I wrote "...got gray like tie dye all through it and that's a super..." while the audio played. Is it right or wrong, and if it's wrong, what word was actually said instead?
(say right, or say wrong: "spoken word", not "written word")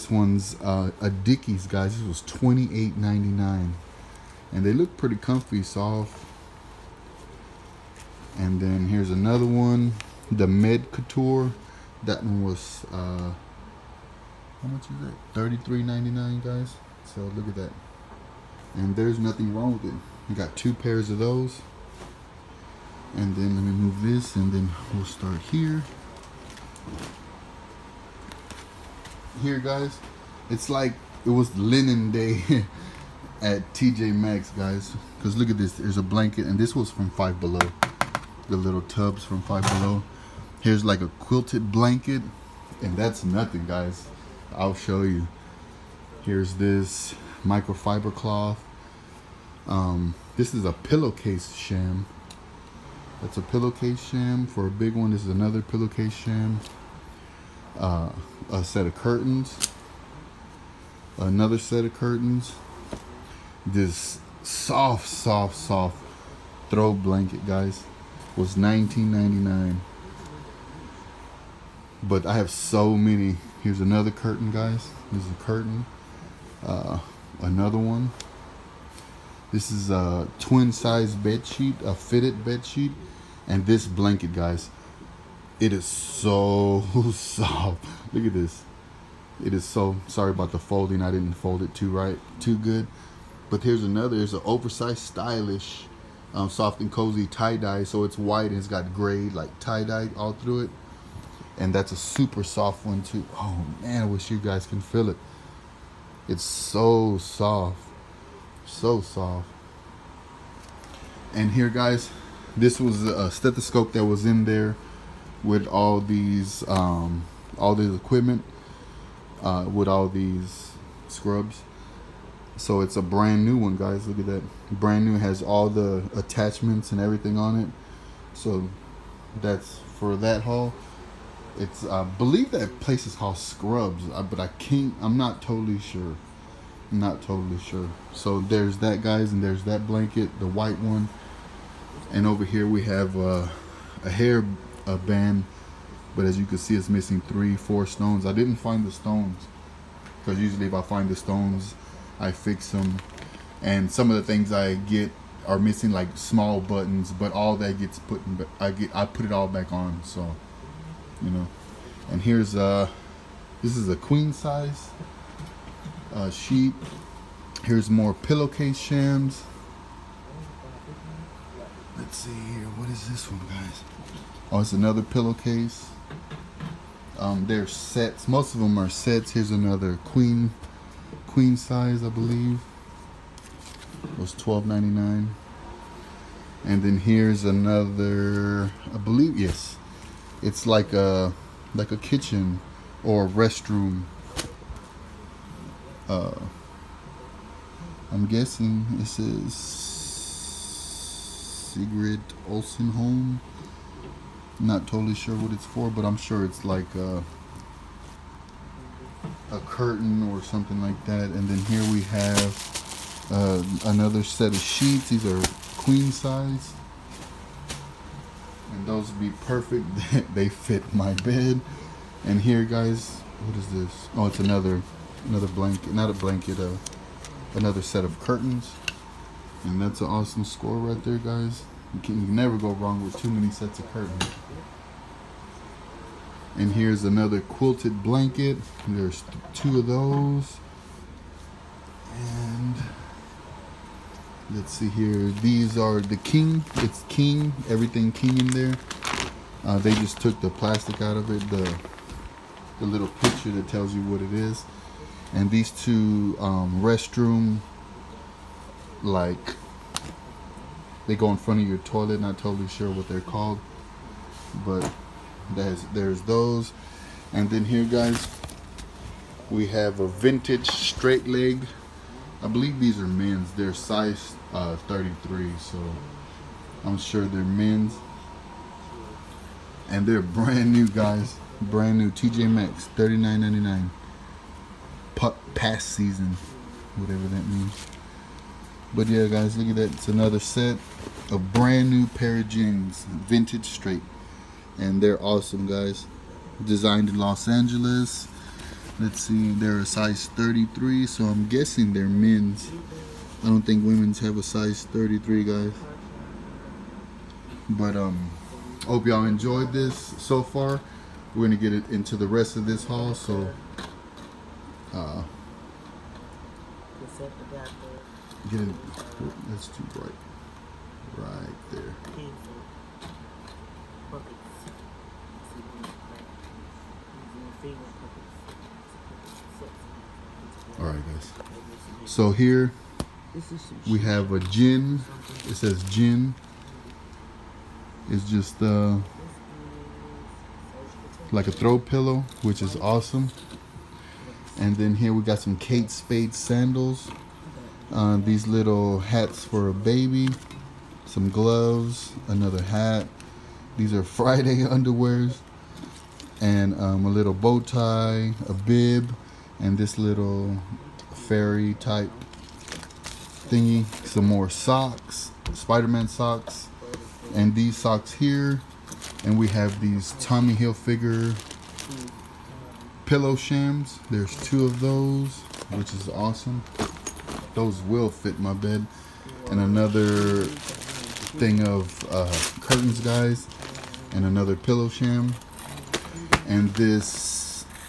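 right.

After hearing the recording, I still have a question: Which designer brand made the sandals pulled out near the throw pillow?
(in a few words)
Kate Spade.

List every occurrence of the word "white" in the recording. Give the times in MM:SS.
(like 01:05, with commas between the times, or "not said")
01:38, 02:20.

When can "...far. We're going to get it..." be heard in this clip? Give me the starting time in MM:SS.
05:10.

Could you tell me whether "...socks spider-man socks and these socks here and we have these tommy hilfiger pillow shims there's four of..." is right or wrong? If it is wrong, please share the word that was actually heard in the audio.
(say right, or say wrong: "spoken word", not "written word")
wrong: "two", not "four".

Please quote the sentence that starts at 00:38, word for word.
The little tubs from Five Below.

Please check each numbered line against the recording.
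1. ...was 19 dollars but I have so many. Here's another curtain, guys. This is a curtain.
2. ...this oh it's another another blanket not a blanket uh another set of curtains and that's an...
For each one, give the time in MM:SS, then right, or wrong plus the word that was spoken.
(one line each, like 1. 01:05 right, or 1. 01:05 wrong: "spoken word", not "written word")
1. 01:08 right
2. 03:43 right.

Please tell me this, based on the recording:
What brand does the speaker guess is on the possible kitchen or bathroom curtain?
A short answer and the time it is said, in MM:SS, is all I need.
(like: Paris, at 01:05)
Sigrid Olsen home, at 03:19.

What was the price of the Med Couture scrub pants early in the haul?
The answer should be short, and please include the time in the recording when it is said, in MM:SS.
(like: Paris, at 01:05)
$33.99, at 00:15.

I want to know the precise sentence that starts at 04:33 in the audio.
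They're size uh, 33, so I'm sure they're men's.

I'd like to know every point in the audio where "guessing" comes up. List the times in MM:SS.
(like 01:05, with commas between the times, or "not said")
03:18, 05:01.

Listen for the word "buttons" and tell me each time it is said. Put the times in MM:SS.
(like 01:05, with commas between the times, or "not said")
02:36.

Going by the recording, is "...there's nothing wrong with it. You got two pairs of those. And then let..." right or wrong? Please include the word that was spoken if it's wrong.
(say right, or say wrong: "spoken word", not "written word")
right.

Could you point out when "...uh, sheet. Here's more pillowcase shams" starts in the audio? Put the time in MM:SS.
02:46.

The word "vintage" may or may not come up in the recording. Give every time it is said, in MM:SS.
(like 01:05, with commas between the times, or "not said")
04:30, 04:53.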